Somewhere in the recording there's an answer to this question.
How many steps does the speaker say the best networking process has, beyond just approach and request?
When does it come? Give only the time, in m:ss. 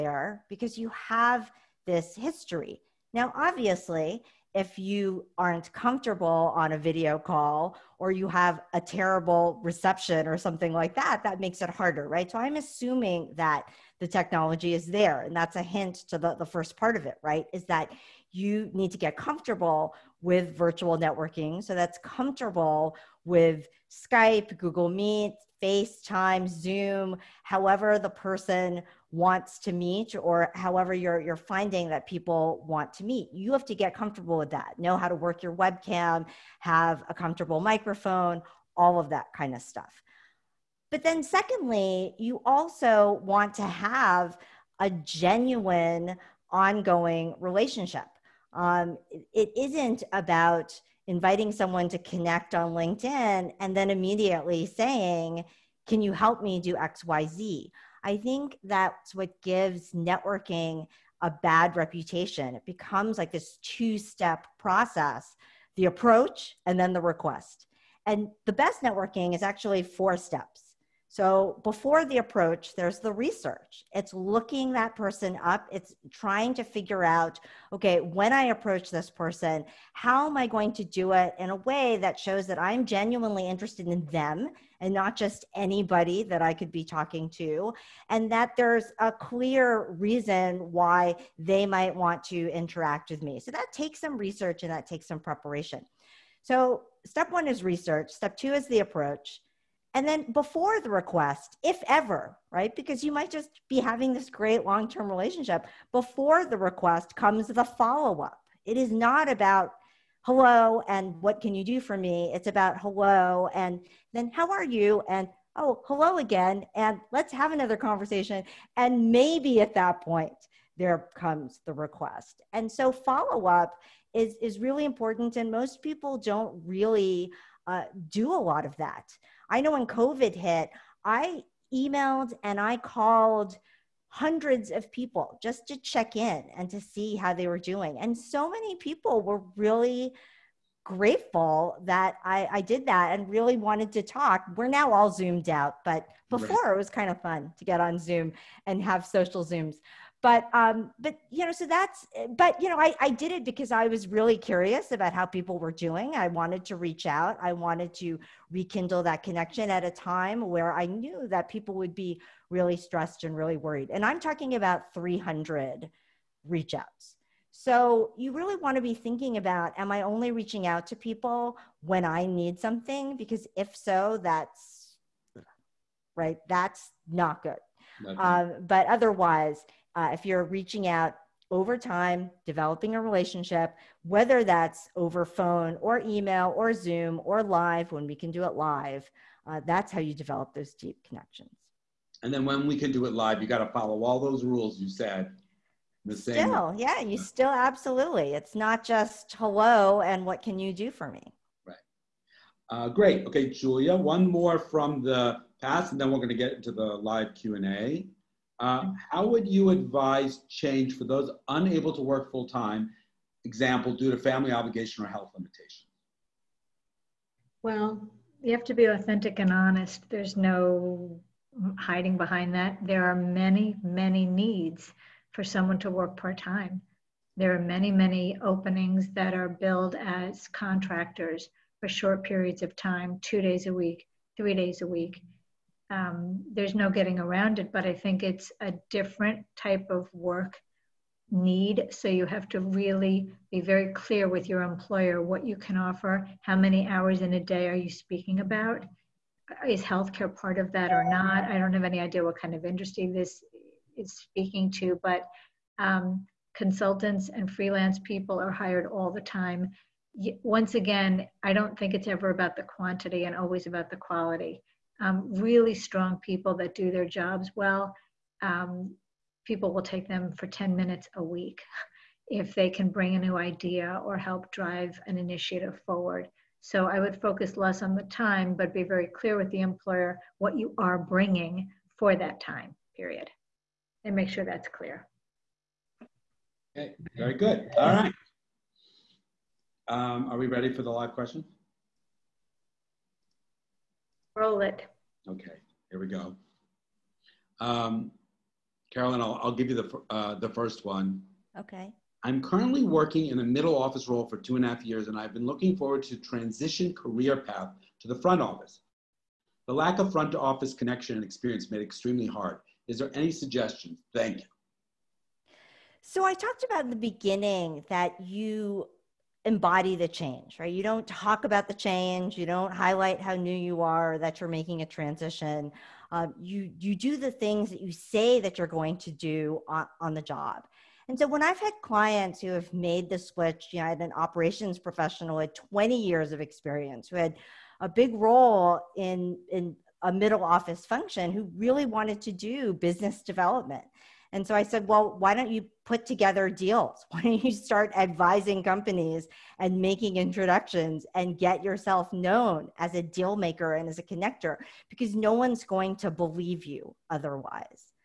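1:09.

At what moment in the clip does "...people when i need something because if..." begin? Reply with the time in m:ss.
2:50.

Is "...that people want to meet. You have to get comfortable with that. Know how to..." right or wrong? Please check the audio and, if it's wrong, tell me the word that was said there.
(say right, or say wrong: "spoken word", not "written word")
right.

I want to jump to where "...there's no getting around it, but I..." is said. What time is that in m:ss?
3:56.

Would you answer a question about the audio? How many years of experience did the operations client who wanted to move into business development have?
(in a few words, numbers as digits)
20.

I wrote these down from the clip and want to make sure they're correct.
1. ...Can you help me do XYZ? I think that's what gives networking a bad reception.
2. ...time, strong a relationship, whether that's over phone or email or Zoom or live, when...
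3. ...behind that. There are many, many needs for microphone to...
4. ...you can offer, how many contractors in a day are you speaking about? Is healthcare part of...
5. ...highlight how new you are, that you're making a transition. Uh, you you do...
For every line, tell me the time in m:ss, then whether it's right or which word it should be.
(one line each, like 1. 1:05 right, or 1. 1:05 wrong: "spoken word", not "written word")
1. 0:55 wrong: "reputation", not "reception"
2. 3:01 wrong: "developing", not "strong"
3. 3:42 wrong: "someone", not "microphone"
4. 4:05 wrong: "hours", not "contractors"
5. 5:22 right.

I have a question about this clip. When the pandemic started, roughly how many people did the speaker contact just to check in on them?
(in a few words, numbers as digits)
300.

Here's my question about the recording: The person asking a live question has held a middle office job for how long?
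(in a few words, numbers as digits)
Two and a half years.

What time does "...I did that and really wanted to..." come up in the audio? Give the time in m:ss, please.
2:22.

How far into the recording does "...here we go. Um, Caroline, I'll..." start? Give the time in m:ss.
4:55.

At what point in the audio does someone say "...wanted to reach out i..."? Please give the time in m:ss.
2:36.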